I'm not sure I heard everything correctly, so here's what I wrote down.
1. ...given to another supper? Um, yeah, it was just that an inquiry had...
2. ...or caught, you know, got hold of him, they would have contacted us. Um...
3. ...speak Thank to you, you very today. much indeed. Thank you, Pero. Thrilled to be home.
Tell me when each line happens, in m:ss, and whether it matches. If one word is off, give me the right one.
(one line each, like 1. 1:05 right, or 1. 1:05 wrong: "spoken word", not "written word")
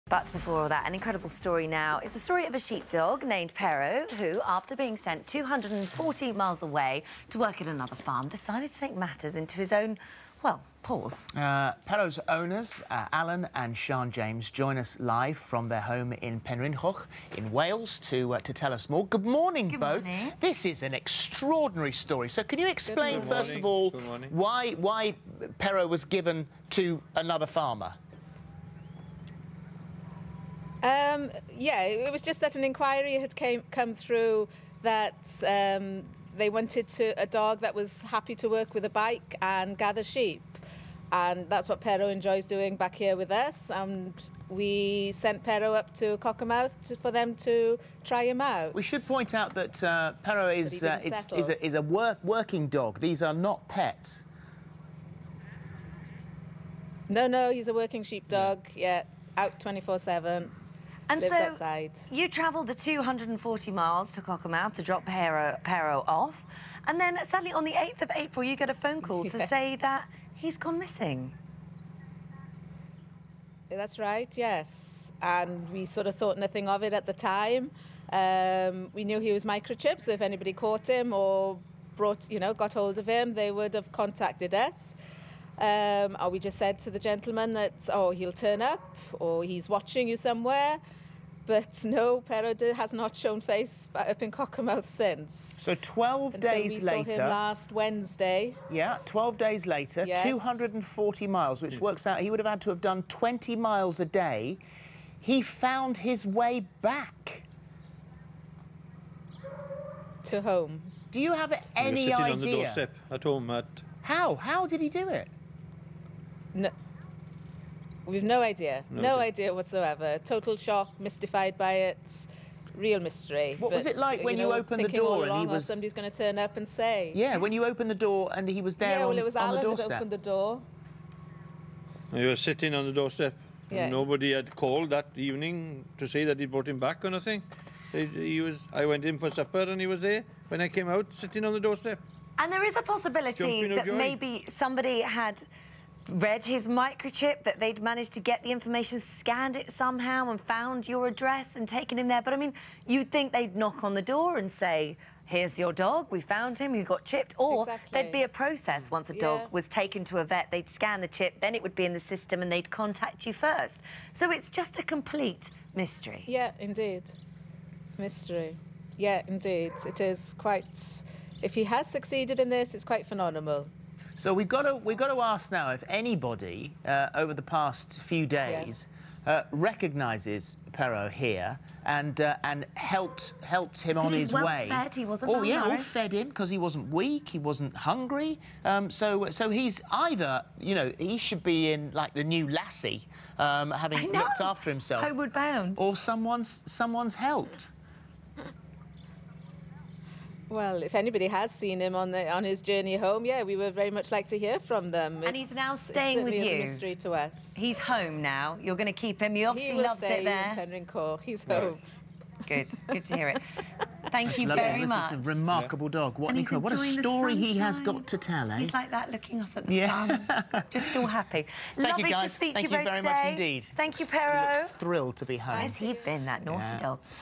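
1. 0:26 wrong: "farmer", not "supper"
2. 1:21 wrong: "brought", not "caught"
3. 3:42 right.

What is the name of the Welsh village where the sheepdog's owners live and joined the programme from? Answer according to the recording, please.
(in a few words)
Penrhyncoch.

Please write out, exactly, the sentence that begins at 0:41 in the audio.
And that's what Pero enjoys doing back here with us.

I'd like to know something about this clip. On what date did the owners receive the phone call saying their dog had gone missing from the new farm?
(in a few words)
8th of April.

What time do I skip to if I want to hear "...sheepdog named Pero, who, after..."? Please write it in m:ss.
0:02.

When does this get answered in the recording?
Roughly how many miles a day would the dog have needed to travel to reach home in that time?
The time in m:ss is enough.
1:43.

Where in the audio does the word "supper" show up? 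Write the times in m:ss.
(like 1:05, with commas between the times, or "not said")
2:19.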